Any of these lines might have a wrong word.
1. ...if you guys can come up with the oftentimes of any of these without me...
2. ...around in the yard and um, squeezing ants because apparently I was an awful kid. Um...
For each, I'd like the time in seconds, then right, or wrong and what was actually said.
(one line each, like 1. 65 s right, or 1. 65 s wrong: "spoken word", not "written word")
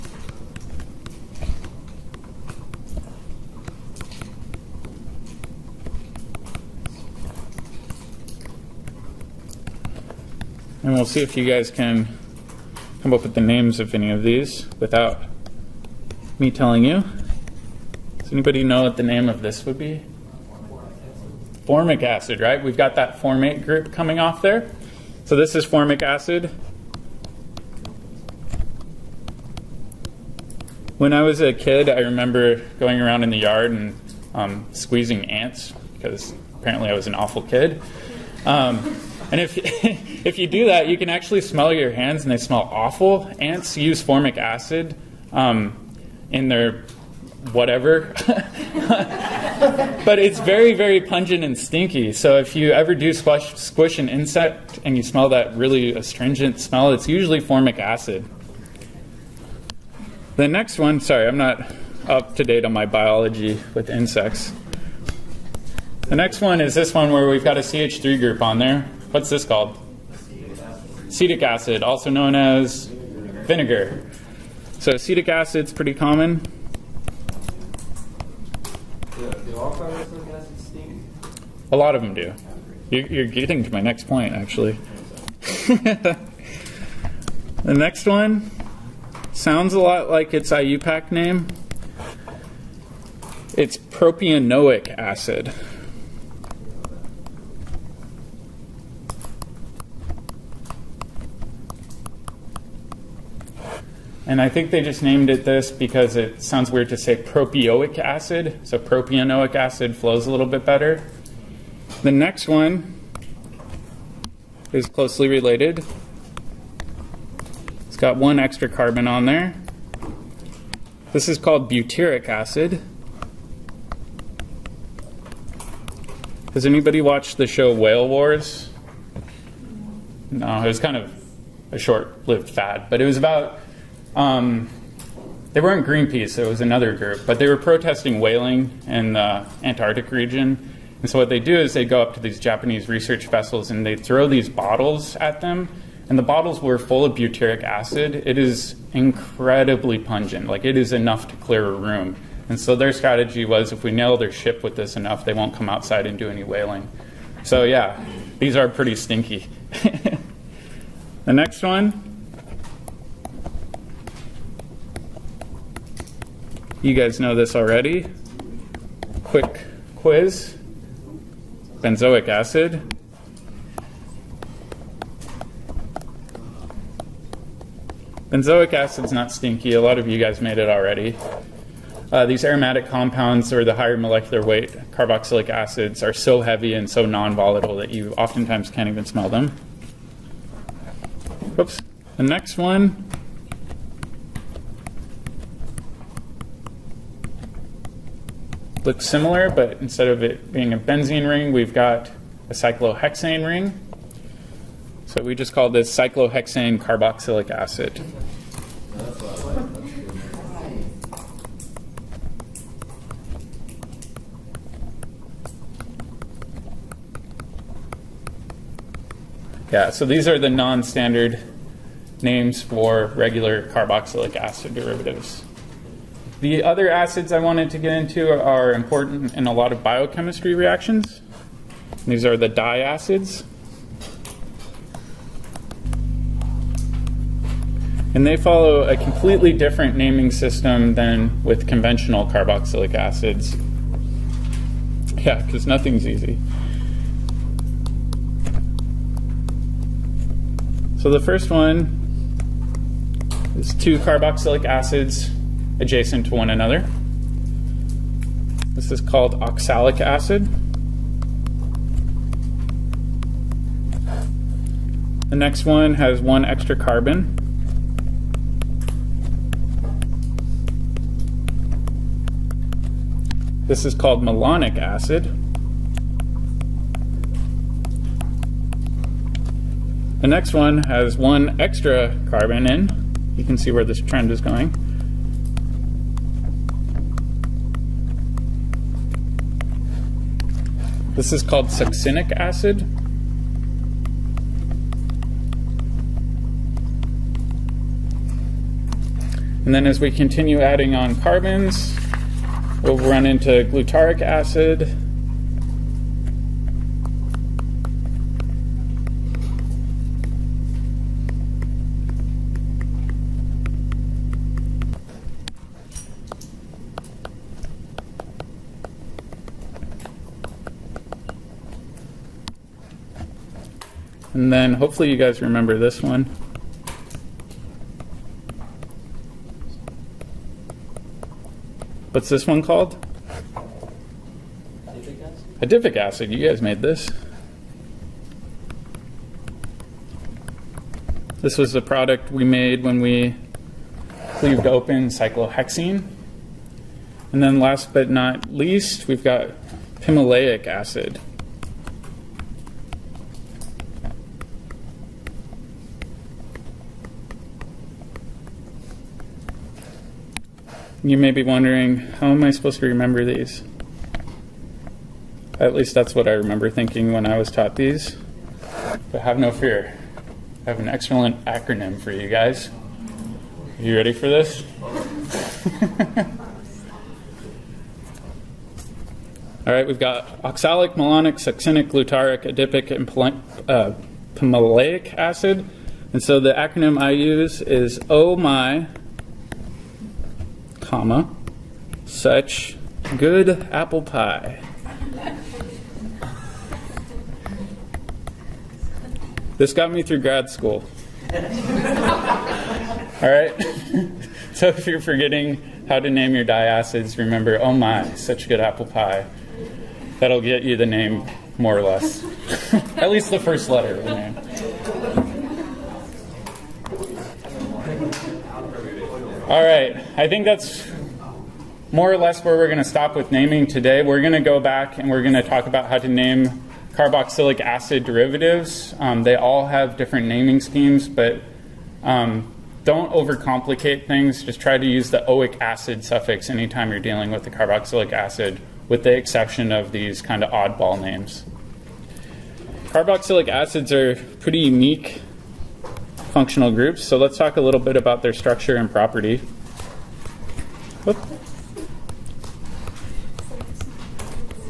1. 11 s wrong: "names", not "oftentimes"
2. 32 s right.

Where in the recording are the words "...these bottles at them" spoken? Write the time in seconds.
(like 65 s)
144 s.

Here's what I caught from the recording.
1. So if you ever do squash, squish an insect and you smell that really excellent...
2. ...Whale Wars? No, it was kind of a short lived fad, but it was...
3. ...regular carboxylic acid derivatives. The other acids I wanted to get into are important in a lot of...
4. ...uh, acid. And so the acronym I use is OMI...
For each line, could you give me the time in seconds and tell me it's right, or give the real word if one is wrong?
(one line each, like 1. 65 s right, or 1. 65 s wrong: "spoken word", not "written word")
1. 52 s wrong: "astringent", not "excellent"
2. 127 s right
3. 223 s right
4. 383 s right.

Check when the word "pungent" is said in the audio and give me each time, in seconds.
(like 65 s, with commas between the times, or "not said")
50 s, 149 s.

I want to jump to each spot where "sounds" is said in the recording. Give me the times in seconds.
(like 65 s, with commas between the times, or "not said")
89 s, 106 s.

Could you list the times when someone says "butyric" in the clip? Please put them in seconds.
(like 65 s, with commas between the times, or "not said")
121 s, 147 s.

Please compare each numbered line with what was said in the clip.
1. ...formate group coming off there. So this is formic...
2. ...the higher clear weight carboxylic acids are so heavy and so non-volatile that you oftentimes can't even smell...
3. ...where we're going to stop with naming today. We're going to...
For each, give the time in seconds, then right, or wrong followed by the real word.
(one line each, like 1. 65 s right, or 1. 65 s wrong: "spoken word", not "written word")
1. 23 s right
2. 183 s wrong: "molecular", not "clear"
3. 422 s right.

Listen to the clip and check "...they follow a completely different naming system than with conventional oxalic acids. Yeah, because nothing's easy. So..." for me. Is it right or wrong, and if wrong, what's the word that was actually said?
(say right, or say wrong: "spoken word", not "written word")
wrong: "carboxylic", not "oxalic".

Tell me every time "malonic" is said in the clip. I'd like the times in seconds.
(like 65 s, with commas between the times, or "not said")
274 s, 380 s.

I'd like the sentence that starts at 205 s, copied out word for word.
So we just call this cyclohexane carboxylic acid.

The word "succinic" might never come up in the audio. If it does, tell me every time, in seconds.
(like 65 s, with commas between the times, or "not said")
291 s, 381 s.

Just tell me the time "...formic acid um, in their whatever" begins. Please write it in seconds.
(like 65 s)
44 s.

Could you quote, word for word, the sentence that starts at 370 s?
I have an excellent acronym for you guys.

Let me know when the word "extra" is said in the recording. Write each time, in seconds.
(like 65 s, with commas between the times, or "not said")
118 s, 266 s, 281 s.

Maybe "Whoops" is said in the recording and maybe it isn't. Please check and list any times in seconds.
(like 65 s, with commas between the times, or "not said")
191 s, 451 s.